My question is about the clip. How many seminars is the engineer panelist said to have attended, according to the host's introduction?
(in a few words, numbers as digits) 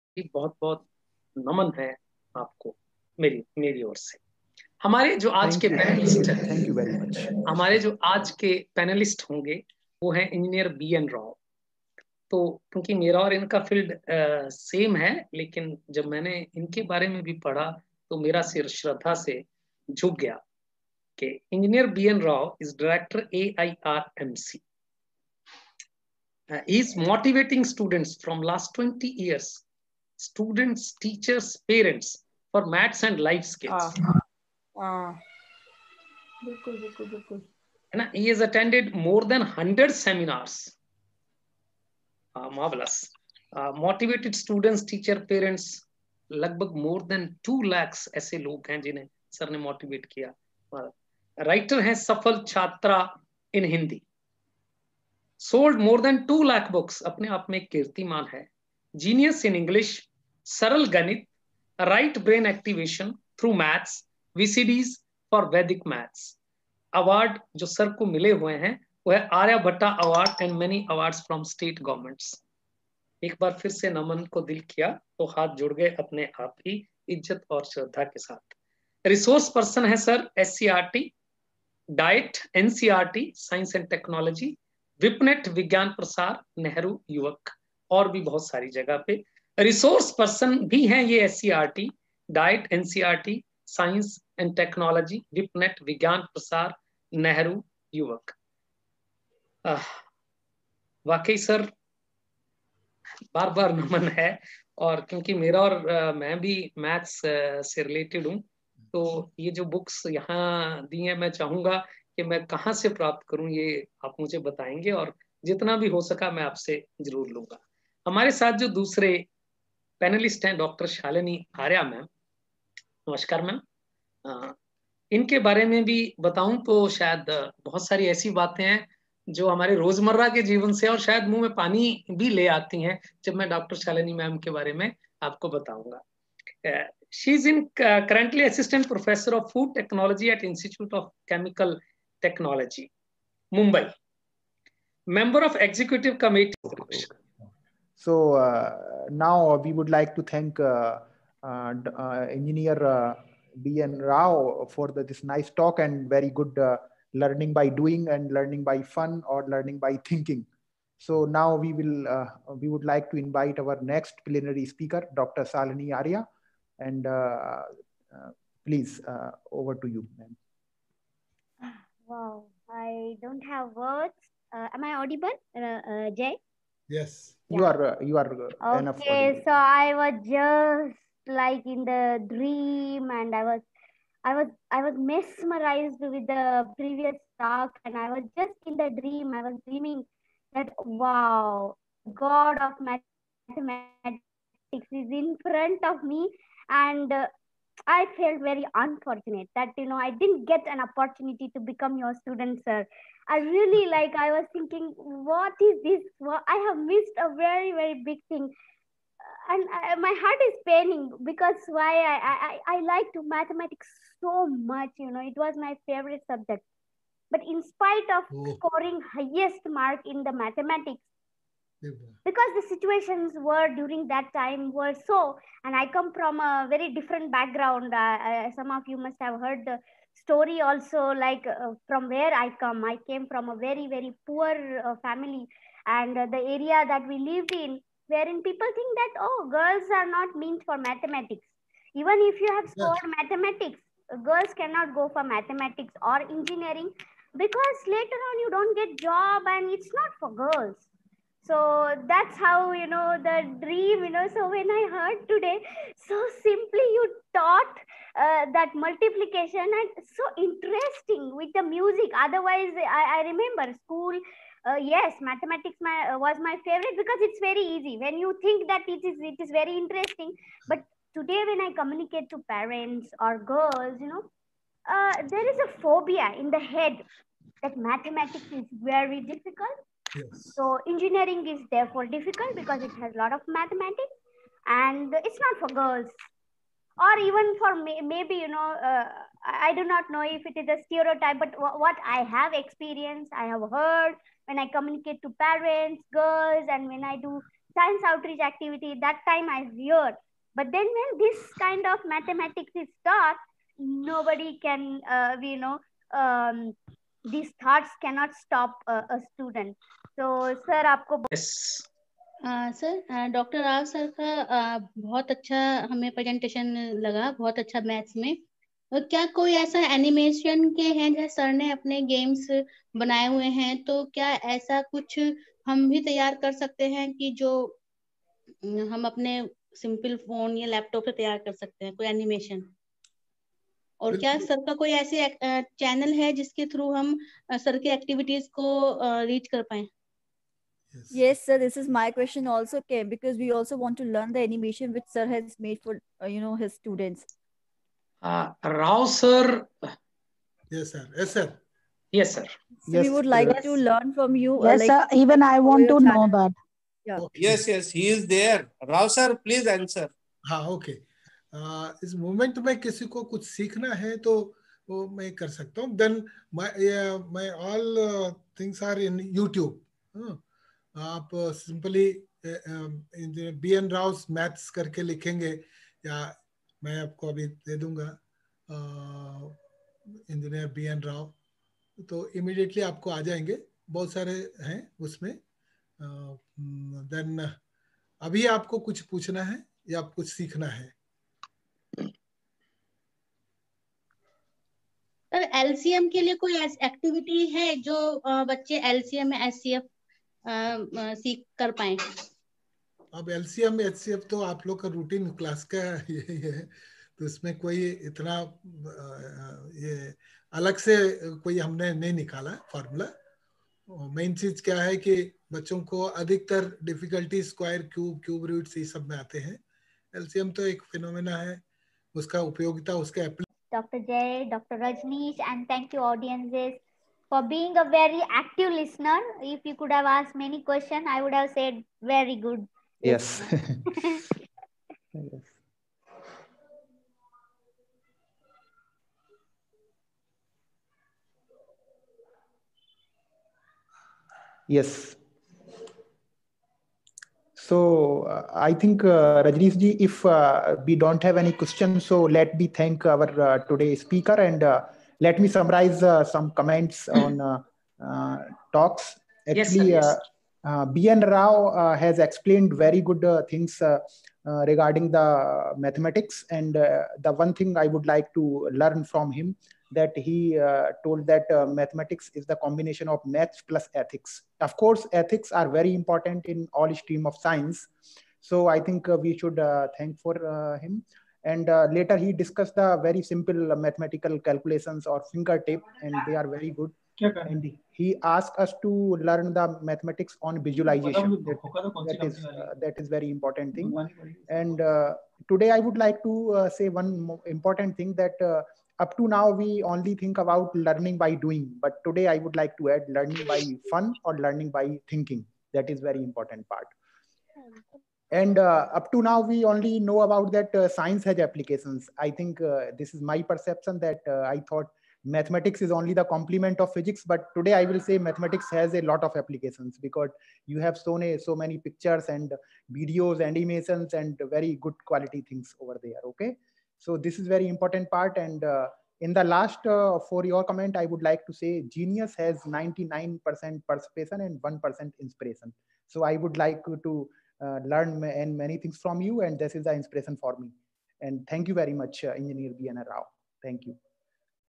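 more than 100.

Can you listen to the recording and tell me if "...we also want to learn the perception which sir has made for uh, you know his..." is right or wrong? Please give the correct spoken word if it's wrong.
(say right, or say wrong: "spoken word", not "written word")
wrong: "animation", not "perception".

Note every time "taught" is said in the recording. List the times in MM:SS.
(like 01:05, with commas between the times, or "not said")
04:17, 05:03.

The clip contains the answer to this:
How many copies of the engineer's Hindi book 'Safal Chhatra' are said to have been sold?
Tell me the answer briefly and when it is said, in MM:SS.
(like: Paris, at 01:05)
more than 2 lakh, at 00:55.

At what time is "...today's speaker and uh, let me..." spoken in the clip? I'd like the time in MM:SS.
07:33.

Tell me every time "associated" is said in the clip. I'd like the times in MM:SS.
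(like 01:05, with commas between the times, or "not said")
not said.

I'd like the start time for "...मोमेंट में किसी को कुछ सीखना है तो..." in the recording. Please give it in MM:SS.
06:02.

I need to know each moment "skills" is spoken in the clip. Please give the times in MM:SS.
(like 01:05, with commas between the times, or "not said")
00:33.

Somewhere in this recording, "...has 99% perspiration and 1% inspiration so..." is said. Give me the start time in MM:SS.
08:52.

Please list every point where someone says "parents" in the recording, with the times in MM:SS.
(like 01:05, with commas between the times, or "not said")
00:31, 00:45, 04:32, 04:55.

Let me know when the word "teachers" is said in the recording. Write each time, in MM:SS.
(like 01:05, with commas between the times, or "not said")
00:31, 00:44.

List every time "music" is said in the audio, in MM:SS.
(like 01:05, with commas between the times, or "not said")
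04:21.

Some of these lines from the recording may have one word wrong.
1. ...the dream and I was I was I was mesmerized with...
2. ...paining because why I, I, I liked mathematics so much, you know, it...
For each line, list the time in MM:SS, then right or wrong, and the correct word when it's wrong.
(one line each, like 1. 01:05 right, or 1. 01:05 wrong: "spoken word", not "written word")
1. 03:01 right
2. 03:30 right.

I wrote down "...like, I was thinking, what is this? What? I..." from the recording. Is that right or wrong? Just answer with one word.
right.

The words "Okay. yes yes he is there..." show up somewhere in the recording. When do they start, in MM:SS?
05:57.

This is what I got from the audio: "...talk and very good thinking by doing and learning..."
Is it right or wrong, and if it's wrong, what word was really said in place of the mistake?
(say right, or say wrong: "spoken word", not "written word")
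wrong: "learning", not "thinking".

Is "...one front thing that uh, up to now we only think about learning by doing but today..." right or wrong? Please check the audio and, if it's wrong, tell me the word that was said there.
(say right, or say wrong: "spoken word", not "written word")
wrong: "important", not "front".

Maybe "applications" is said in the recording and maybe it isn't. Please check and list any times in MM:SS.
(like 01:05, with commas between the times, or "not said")
08:31, 08:39.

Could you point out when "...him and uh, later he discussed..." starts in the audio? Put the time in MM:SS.
08:00.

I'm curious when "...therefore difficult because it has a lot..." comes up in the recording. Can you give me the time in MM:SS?
04:41.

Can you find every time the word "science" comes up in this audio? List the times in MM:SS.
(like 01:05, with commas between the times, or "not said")
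04:57, 07:57, 08:30.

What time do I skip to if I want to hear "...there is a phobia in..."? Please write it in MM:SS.
04:35.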